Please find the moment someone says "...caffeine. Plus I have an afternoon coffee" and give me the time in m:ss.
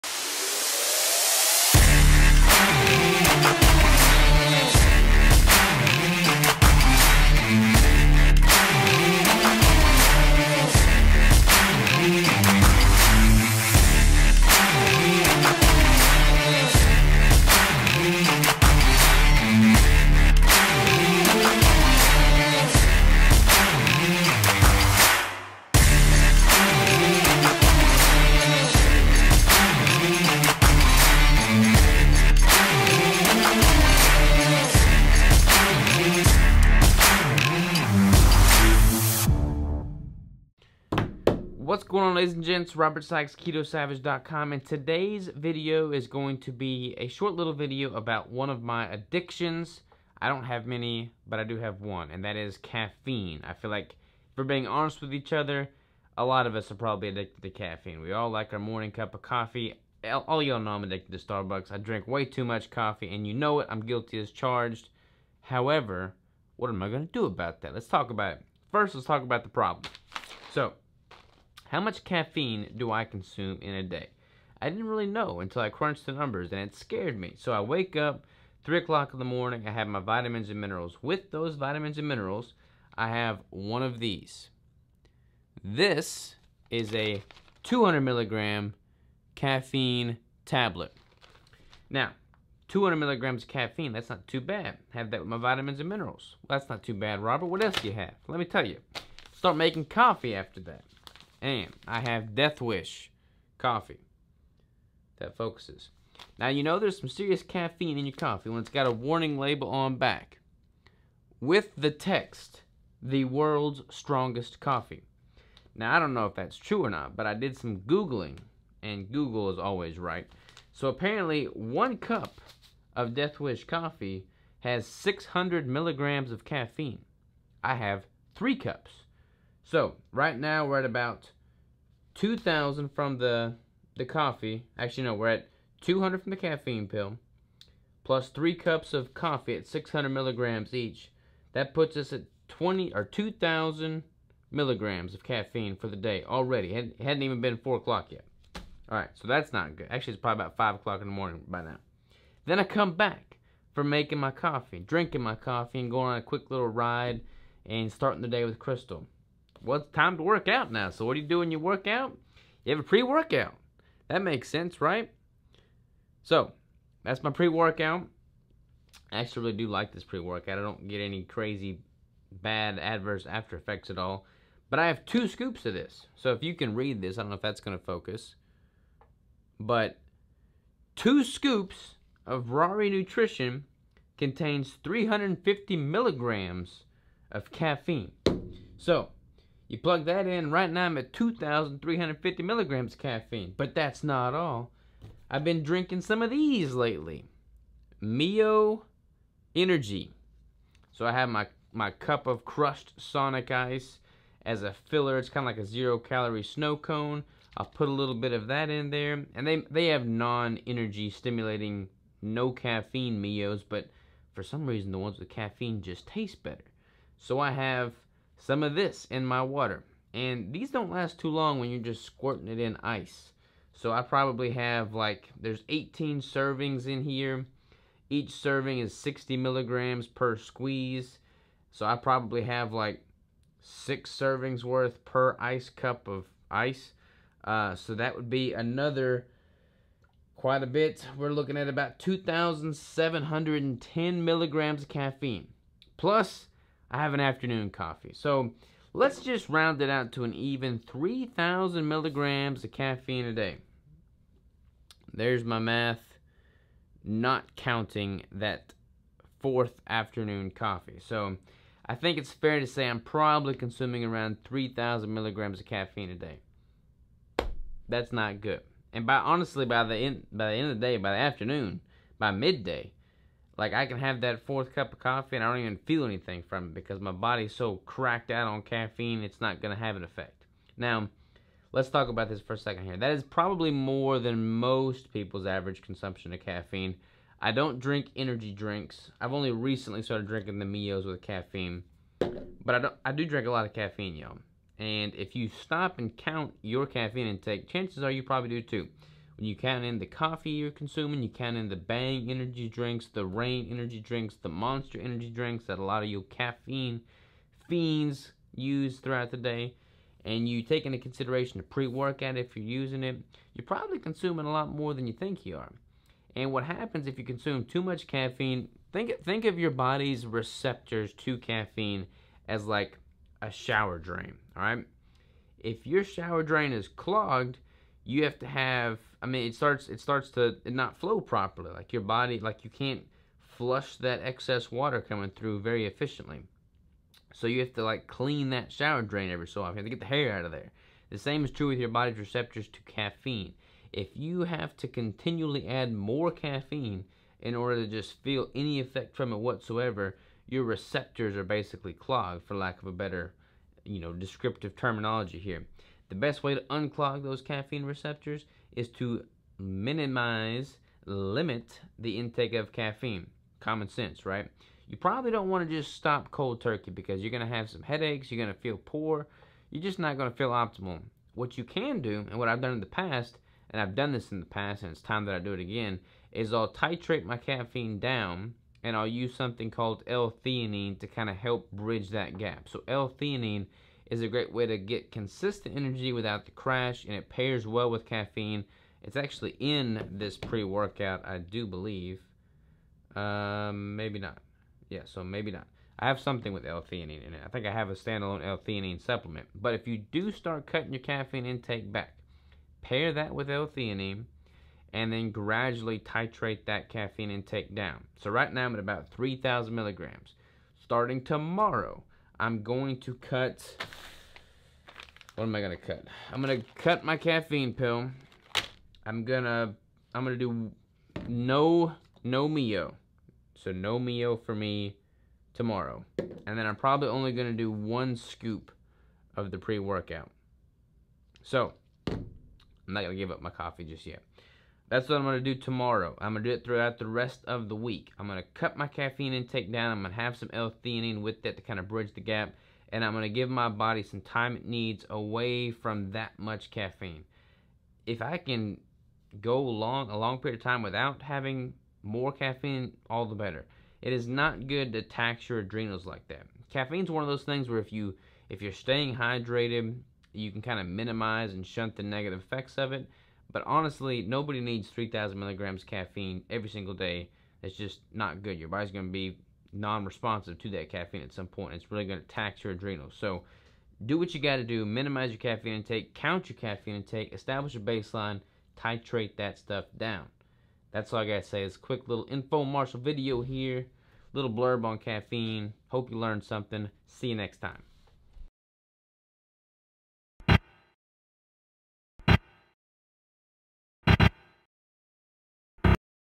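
4:04.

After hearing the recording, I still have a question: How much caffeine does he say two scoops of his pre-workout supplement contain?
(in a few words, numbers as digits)
350 milligrams.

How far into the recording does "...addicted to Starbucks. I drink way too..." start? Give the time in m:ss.
1:00.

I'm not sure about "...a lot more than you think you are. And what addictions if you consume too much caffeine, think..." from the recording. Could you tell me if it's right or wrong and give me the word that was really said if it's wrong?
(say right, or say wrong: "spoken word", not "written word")
wrong: "happens", not "addictions".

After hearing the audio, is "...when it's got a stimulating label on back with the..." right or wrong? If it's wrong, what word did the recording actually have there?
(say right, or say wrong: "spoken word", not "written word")
wrong: "warning", not "stimulating".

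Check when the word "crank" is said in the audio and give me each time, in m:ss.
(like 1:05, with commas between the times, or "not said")
not said.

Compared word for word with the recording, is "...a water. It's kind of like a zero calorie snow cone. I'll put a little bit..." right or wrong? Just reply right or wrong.
wrong.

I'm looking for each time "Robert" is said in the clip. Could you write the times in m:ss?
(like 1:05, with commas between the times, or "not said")
0:42, 1:37.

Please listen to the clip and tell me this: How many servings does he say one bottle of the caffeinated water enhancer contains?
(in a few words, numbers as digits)
18.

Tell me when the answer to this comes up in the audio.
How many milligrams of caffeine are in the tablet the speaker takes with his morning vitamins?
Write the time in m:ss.
1:27.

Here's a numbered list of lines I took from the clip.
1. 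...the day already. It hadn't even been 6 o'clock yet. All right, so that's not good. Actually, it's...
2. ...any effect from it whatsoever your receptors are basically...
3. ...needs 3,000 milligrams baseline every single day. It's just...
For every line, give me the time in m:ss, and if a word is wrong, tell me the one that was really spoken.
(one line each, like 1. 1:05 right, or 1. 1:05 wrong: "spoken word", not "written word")
1. 2:25 wrong: "4", not "6"
2. 5:48 right
3. 7:44 wrong: "caffeine", not "baseline".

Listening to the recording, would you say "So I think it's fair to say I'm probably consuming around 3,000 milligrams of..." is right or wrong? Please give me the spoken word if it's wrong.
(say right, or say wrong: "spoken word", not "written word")
right.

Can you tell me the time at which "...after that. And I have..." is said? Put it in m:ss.
1:40.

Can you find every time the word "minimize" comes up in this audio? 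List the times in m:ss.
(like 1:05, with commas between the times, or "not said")
5:59, 7:40, 7:54.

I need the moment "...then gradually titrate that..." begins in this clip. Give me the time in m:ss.
6:45.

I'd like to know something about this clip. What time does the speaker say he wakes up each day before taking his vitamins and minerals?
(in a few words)
3 o'clock.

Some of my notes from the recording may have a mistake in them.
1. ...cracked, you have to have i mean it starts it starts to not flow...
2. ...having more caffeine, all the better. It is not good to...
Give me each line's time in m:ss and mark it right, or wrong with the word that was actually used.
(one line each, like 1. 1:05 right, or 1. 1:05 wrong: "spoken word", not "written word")
1. 5:26 wrong: "clogged", not "cracked"
2. 7:31 right.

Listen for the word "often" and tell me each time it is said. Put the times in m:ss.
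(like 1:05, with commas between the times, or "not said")
5:39.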